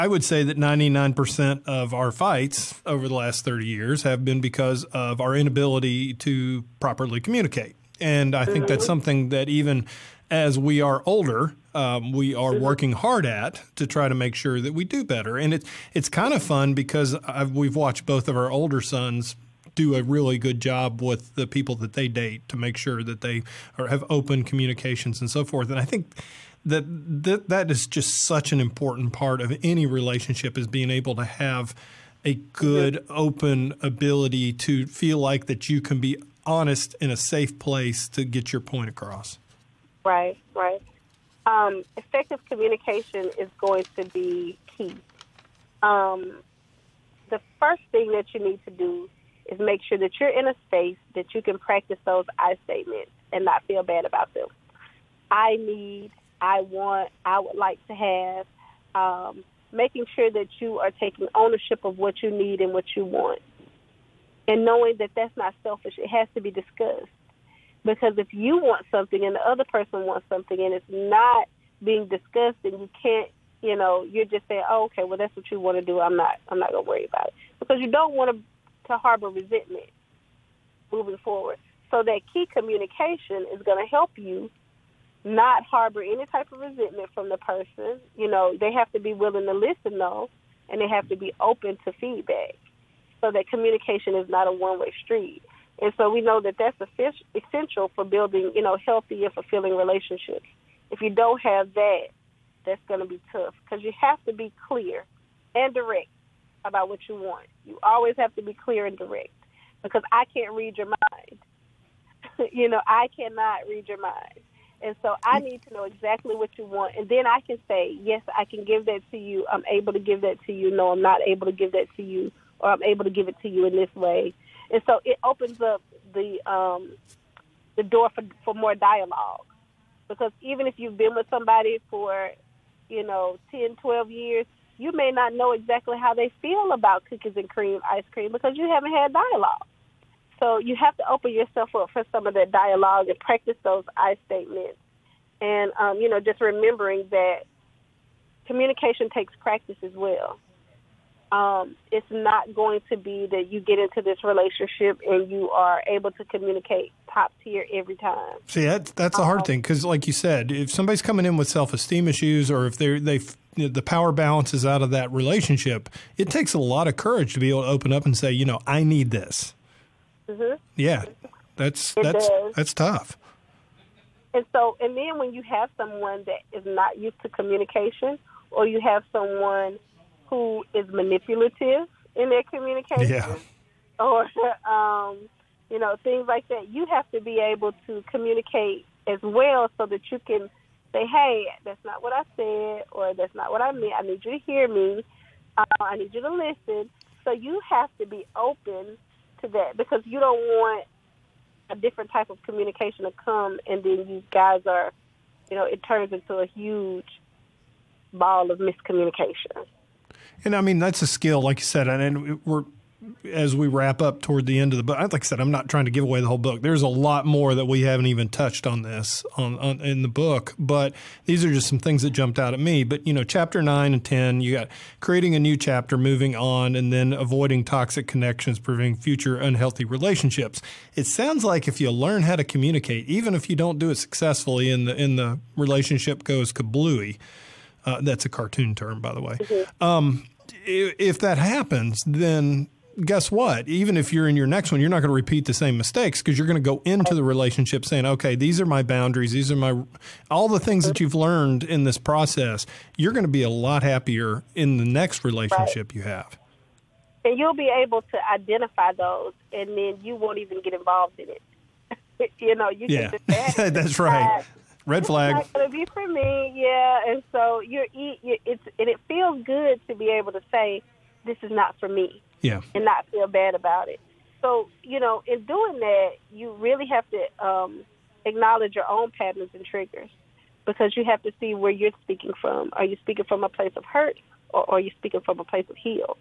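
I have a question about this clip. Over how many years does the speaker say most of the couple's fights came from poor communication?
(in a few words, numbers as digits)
30.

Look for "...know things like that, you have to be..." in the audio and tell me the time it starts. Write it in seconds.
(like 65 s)
185 s.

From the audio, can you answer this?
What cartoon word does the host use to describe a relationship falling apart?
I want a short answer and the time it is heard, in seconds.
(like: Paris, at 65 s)
kablooey, at 236 s.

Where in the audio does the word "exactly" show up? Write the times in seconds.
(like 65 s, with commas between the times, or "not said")
115 s, 135 s.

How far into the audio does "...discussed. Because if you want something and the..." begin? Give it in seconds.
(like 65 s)
66 s.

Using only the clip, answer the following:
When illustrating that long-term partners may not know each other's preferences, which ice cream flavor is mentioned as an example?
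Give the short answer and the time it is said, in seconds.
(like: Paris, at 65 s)
cookies and cream, at 137 s.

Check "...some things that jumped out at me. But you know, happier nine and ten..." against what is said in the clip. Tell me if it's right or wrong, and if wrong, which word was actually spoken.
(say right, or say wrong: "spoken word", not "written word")
wrong: "chapter", not "happier".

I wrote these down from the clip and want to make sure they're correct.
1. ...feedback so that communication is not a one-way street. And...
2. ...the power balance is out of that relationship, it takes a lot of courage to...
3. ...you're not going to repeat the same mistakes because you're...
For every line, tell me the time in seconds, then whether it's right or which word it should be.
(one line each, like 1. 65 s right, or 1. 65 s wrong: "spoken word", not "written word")
1. 91 s right
2. 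163 s right
3. 244 s right.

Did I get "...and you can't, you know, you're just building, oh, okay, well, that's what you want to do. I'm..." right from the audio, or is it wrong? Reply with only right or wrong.
wrong.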